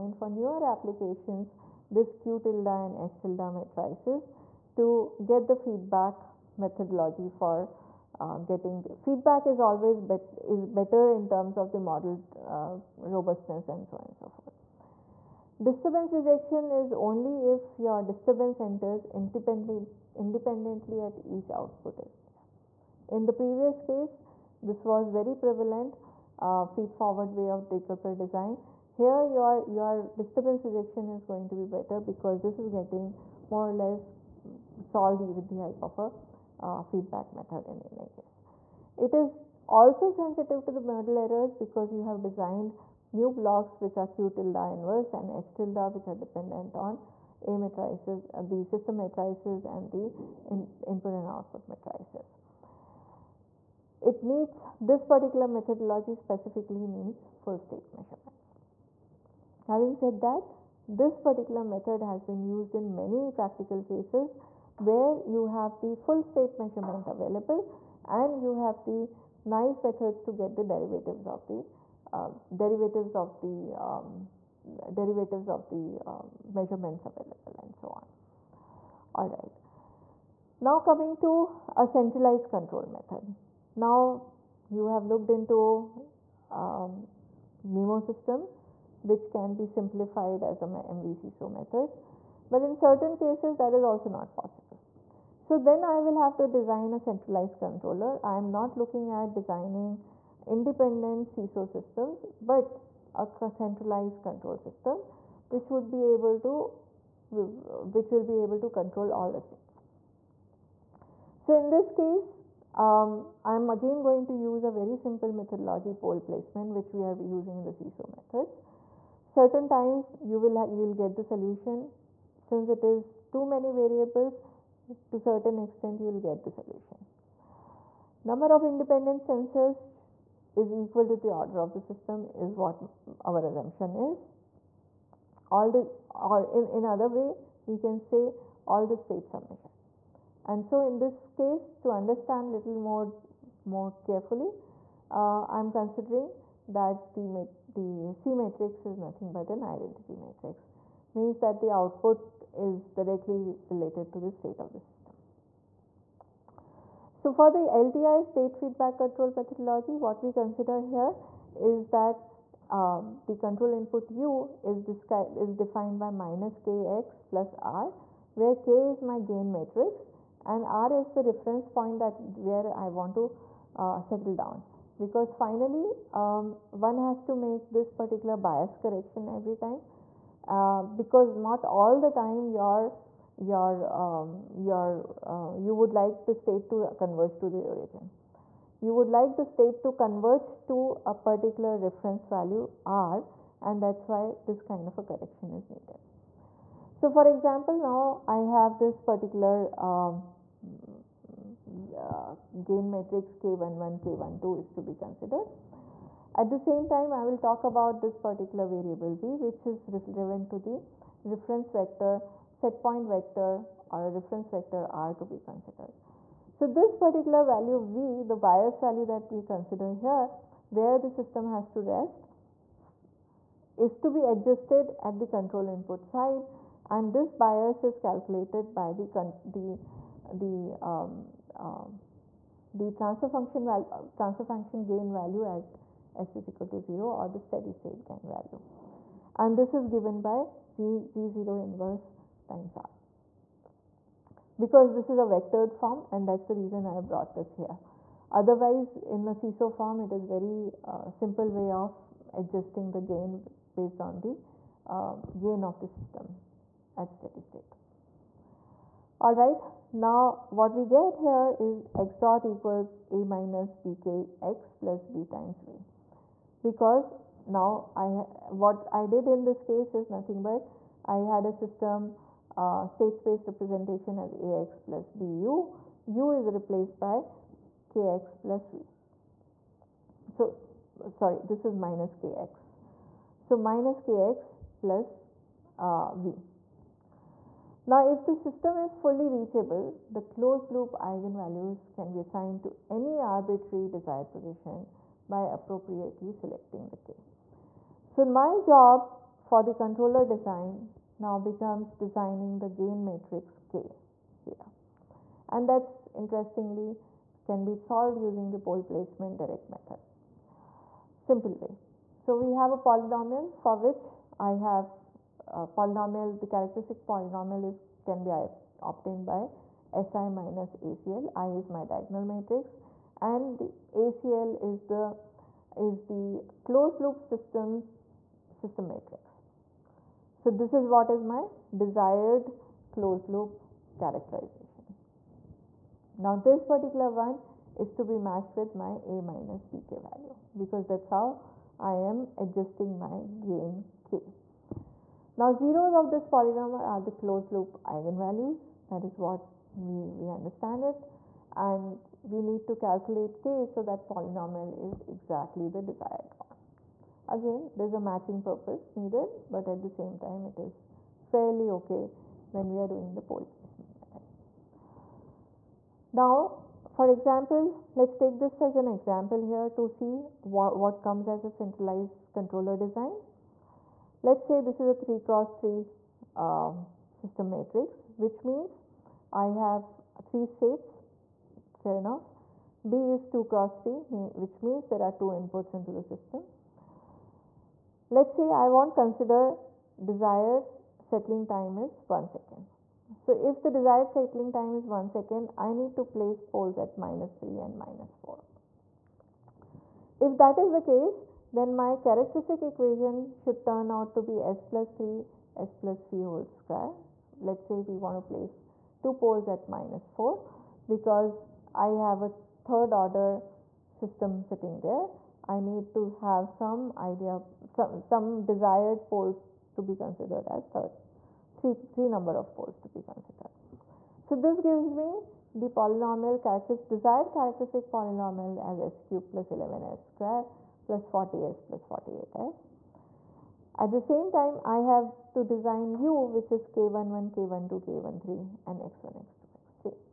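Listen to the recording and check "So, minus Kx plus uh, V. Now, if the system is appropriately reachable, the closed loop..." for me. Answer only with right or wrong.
wrong.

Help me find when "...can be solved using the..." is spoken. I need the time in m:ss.
5:07.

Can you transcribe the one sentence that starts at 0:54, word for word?
It needs this particular methodology specifically needs full state measurements.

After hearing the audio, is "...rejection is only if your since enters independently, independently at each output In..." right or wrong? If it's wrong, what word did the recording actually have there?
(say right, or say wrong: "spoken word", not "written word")
wrong: "disturbance", not "since".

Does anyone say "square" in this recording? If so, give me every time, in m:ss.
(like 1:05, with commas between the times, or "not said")
6:46, 7:09.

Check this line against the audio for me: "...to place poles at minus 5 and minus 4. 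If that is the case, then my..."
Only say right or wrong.
wrong.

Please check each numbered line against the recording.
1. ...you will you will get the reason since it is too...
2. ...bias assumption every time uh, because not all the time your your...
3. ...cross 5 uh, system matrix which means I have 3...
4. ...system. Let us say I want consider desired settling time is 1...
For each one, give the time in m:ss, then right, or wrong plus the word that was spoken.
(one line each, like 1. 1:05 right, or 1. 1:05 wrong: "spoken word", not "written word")
1. 2:00 wrong: "solution", not "reason"
2. 2:58 wrong: "correction", not "assumption"
3. 6:15 wrong: "3", not "5"
4. 6:26 right.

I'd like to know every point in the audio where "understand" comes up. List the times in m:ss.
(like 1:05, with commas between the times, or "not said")
2:21, 5:50.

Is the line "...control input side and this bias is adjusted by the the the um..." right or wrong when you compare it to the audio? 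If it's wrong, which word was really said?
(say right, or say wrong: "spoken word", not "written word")
wrong: "calculated", not "adjusted".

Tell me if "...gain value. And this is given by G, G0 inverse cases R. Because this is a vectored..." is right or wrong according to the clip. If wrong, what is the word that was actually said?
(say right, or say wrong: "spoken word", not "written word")
wrong: "times", not "cases".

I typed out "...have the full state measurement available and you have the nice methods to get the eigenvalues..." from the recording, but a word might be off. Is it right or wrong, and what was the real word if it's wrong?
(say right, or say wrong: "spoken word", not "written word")
wrong: "derivatives", not "eigenvalues".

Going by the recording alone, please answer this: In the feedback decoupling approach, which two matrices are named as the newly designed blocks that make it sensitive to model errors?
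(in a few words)
Q tilde inverse and H tilde.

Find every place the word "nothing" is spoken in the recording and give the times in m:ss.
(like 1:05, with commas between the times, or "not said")
2:28, 4:30.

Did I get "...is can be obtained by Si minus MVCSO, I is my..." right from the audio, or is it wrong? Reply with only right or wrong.
wrong.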